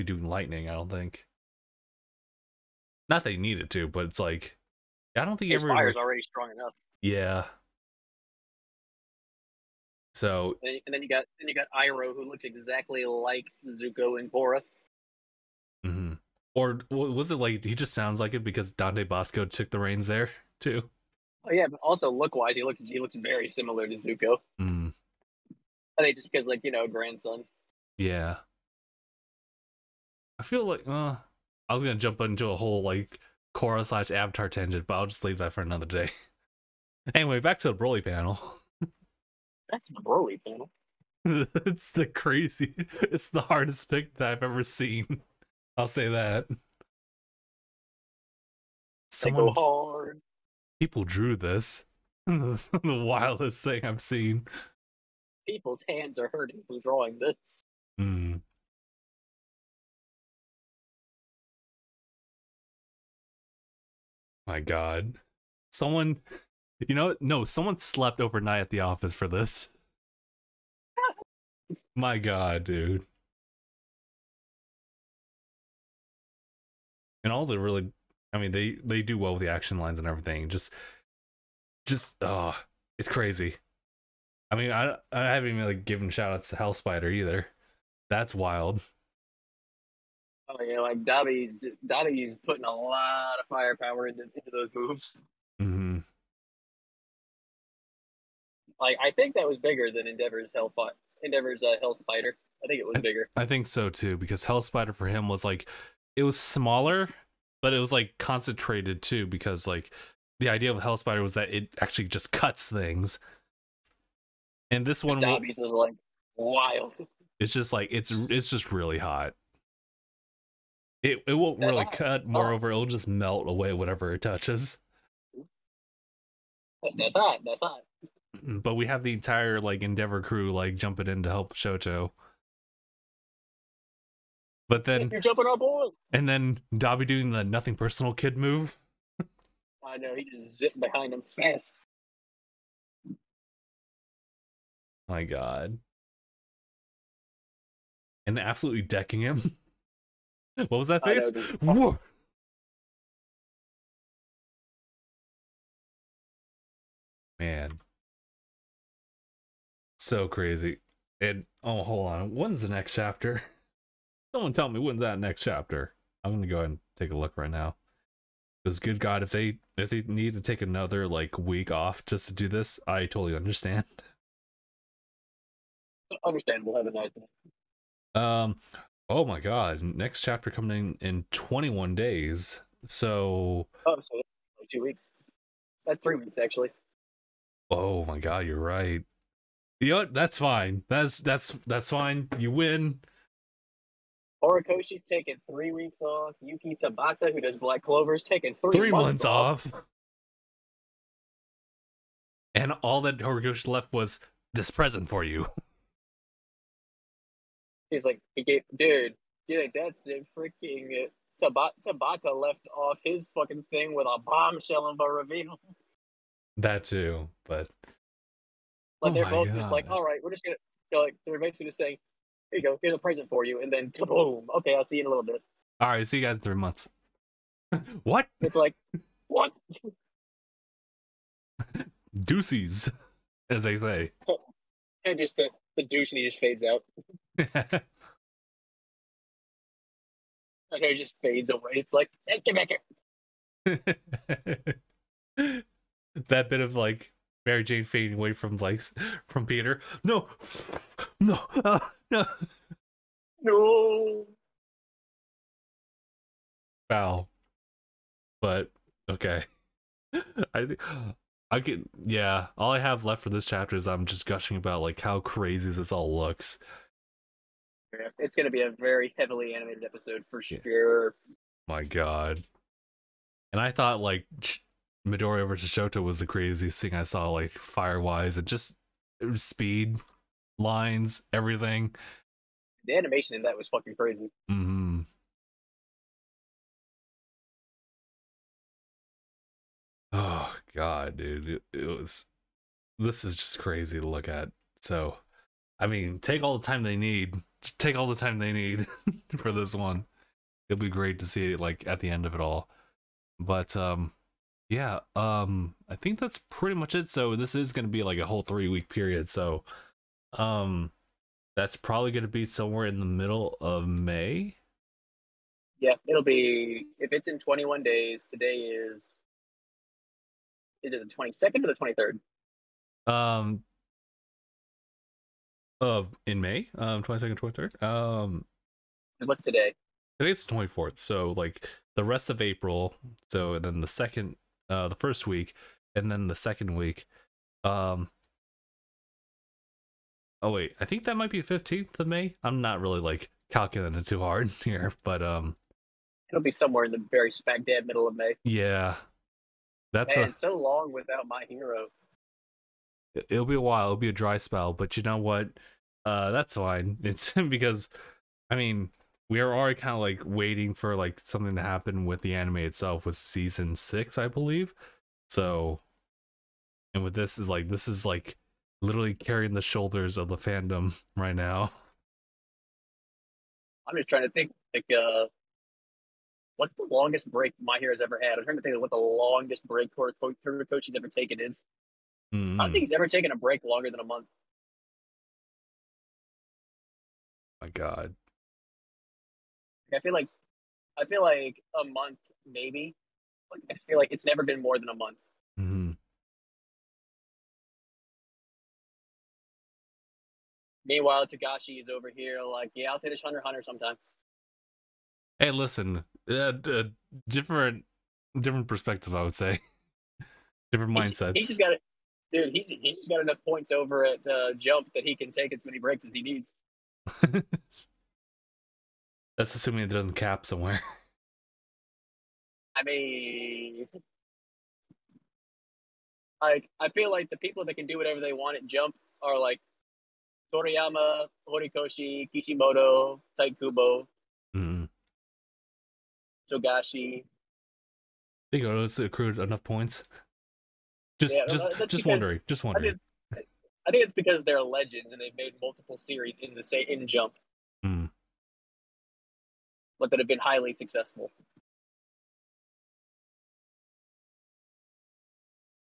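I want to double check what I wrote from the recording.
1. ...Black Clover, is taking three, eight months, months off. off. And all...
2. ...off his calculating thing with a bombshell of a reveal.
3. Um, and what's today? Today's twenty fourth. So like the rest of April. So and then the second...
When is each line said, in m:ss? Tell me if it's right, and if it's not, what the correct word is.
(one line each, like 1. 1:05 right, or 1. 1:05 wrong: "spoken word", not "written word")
1. 3:17 wrong: "three", not "eight"
2. 3:32 wrong: "fucking", not "calculating"
3. 5:27 right.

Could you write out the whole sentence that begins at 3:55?
and just the, the douche, and he just fades out.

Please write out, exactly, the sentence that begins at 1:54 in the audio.
And this one Dabi's was like wild.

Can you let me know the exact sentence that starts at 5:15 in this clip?
Yeah, it'll be if it's in twenty one days, today is is it the twenty second or the twenty third?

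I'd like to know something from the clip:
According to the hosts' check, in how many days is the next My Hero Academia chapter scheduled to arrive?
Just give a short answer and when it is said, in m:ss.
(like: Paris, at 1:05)
21, at 3:01.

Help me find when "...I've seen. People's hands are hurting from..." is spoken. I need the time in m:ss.
0:53.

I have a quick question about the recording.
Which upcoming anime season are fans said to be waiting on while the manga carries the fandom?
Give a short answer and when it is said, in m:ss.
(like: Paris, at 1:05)
season six, at 6:03.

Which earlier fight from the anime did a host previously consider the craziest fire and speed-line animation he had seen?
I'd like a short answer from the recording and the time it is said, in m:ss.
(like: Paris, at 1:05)
Midoriya versus Shoto, at 4:35.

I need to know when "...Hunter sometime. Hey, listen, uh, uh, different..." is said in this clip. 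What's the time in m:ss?
6:43.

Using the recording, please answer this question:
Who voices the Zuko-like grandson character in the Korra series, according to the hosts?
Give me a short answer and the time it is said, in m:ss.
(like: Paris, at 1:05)
Dante Basco, at 0:18.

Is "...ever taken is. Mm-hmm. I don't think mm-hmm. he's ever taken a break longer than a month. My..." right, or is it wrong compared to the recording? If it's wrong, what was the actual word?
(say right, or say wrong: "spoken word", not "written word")
right.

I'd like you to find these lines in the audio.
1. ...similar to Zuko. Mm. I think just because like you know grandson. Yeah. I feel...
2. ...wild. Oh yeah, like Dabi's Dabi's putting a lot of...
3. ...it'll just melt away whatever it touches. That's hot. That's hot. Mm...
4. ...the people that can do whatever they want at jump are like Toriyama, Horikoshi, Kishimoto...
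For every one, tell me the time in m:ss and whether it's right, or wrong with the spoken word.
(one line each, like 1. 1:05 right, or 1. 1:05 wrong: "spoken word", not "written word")
1. 0:23 right
2. 1:28 right
3. 2:02 right
4. 7:07 right.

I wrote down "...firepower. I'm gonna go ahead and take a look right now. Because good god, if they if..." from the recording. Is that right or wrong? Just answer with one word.
wrong.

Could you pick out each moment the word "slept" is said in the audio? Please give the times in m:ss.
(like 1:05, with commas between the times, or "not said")
1:07.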